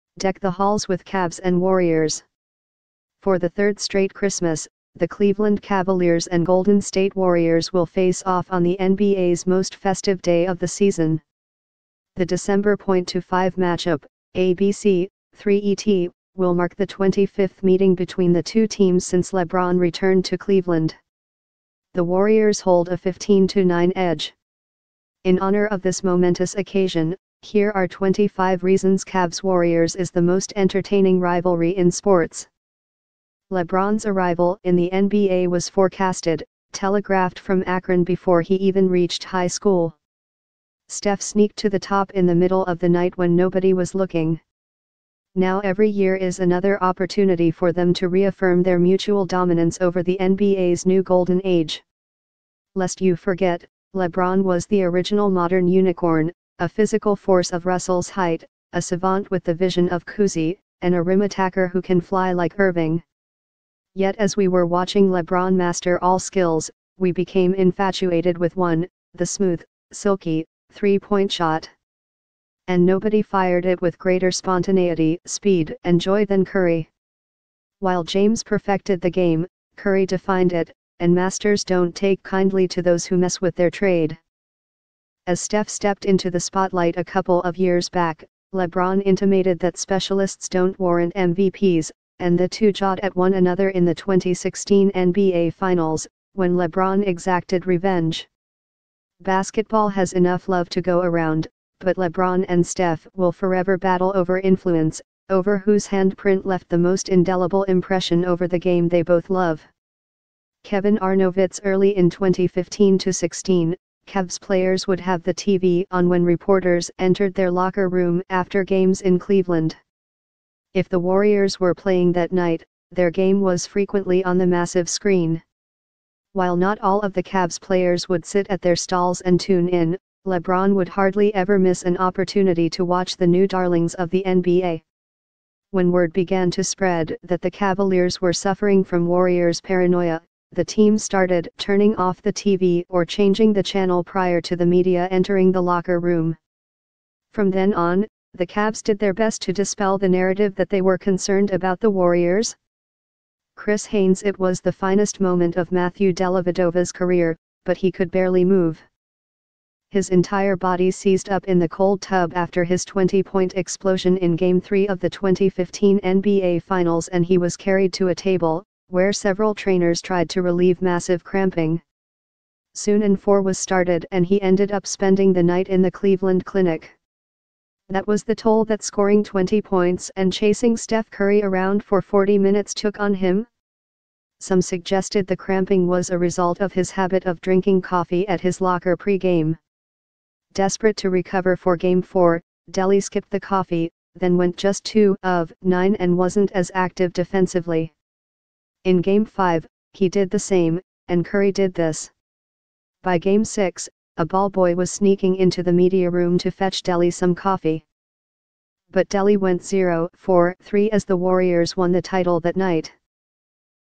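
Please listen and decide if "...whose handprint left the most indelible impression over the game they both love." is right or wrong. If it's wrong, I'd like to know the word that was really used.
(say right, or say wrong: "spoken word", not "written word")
right.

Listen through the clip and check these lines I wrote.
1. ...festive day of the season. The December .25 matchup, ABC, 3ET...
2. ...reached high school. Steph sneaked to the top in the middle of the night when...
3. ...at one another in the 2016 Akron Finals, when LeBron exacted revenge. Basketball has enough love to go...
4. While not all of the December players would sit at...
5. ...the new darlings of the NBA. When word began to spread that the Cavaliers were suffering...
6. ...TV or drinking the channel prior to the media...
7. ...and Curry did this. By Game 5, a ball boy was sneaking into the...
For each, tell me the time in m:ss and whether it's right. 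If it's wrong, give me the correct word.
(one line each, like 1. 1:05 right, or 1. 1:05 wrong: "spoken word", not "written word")
1. 0:09 right
2. 0:38 right
3. 1:33 wrong: "NBA", not "Akron"
4. 2:06 wrong: "Cavs", not "December"
5. 2:13 right
6. 2:22 wrong: "changing", not "drinking"
7. 3:21 wrong: "6", not "5".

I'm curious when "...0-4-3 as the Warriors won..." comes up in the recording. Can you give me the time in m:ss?
3:29.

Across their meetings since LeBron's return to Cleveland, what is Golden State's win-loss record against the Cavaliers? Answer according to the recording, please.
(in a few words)
15-9.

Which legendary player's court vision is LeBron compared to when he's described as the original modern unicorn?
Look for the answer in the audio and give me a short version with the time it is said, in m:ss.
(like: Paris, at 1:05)
Cousy, at 1:00.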